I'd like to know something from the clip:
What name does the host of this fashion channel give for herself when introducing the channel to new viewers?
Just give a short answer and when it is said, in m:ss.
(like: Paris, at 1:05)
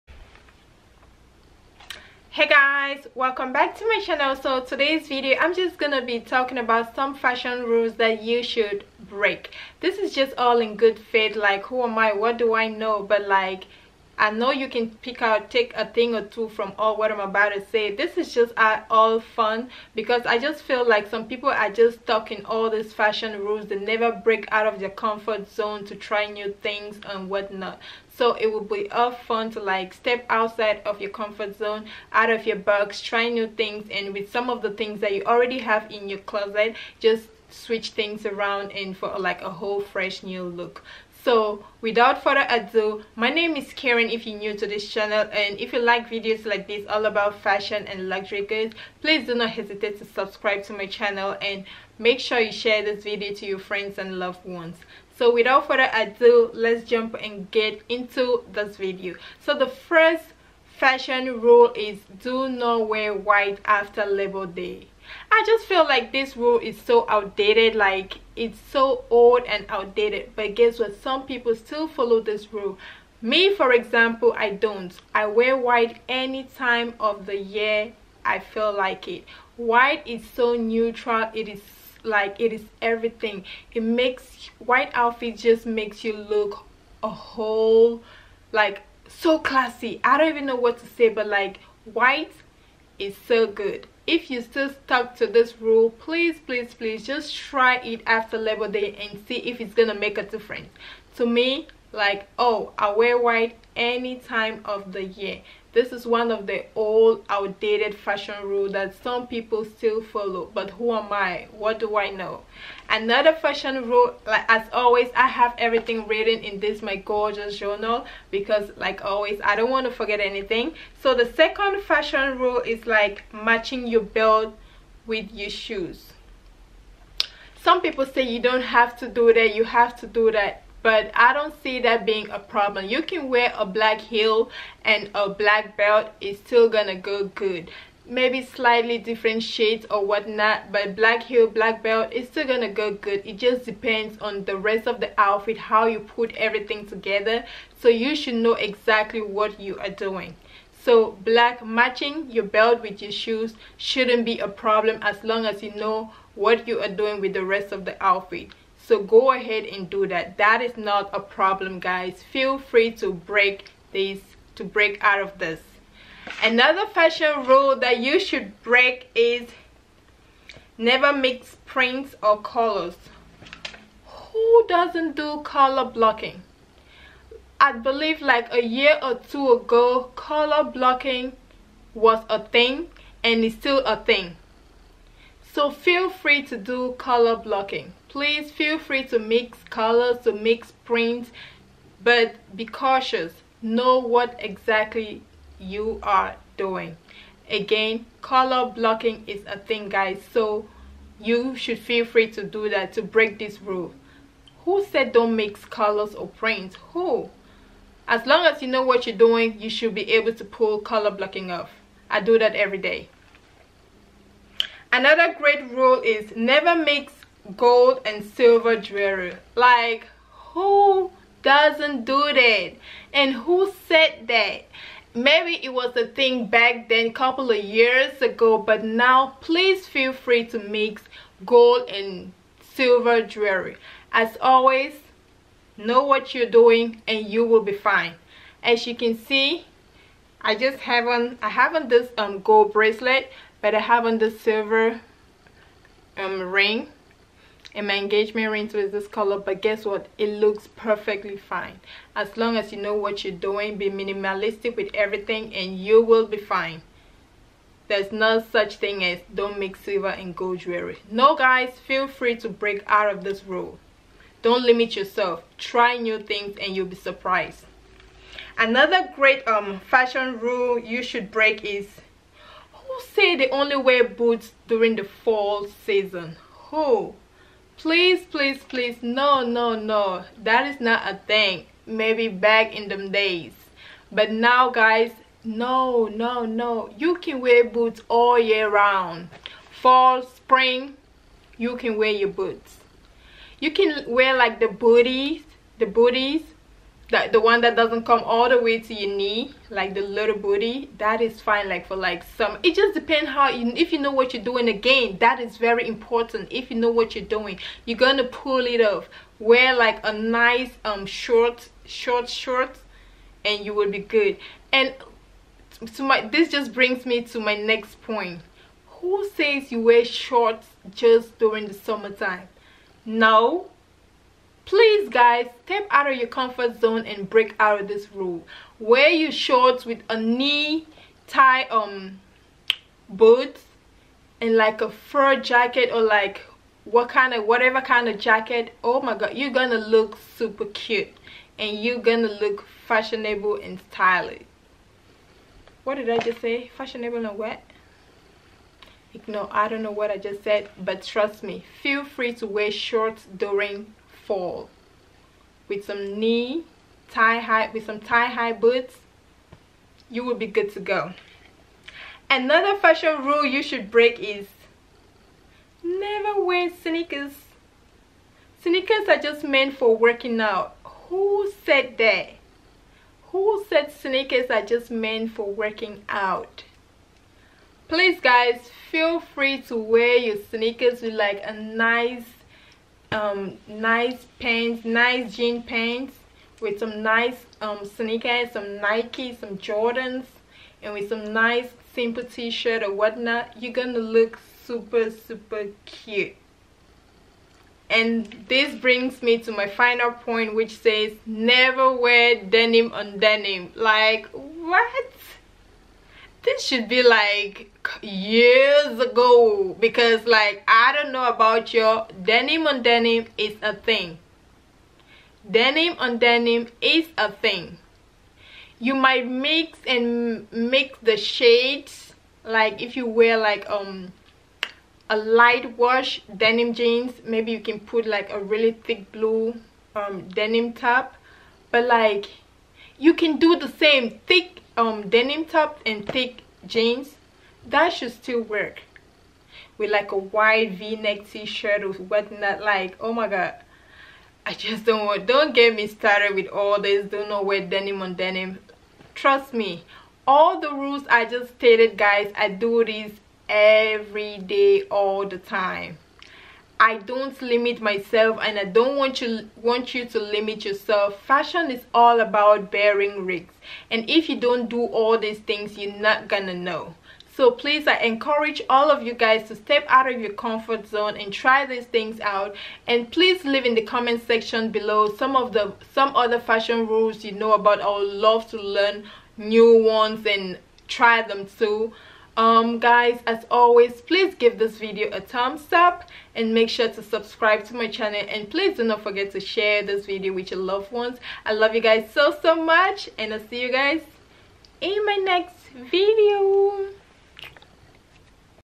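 Karen, at 0:43.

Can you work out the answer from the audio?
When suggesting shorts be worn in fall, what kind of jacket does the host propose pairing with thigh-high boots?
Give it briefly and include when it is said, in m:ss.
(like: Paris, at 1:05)
a fur jacket, at 5:34.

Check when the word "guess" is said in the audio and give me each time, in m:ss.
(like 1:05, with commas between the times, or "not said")
1:10, 4:09.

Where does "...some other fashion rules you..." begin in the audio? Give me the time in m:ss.
7:55.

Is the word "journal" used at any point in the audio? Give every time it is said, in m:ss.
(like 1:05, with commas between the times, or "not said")
1:57.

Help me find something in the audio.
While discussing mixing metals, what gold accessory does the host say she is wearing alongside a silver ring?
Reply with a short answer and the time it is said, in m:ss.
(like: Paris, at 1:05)
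bracelet, at 4:02.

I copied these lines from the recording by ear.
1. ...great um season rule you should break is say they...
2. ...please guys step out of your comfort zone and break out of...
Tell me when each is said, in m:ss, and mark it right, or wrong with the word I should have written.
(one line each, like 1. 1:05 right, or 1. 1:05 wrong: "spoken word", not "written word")
1. 4:29 wrong: "fashion", not "season"
2. 5:24 right.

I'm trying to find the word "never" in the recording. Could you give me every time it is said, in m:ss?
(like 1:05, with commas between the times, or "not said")
0:23, 2:50, 3:36, 6:05, 6:41.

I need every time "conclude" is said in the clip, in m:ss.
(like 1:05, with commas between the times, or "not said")
not said.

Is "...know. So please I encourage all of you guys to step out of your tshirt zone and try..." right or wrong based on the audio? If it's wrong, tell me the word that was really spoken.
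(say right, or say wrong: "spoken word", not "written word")
wrong: "comfort", not "tshirt".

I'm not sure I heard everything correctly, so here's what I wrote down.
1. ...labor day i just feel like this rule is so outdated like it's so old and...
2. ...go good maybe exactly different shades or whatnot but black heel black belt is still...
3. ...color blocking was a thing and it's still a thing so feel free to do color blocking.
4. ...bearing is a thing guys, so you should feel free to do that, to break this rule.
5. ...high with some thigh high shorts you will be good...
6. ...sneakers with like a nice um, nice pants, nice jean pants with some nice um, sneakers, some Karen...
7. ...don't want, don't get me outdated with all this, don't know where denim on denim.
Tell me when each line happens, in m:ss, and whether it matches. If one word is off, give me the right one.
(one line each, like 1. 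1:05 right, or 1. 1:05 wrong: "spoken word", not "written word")
1. 1:04 right
2. 2:16 wrong: "slightly", not "exactly"
3. 3:00 right
4. 3:18 wrong: "blocking", not "bearing"
5. 5:57 wrong: "boots", not "shorts"
6. 6:20 wrong: "Nike", not "Karen"
7. 7:24 wrong: "started", not "outdated".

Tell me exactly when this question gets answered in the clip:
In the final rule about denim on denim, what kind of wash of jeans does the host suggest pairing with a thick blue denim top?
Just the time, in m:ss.
7:05.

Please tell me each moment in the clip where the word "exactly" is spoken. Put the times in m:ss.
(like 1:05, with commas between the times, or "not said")
2:28, 3:14.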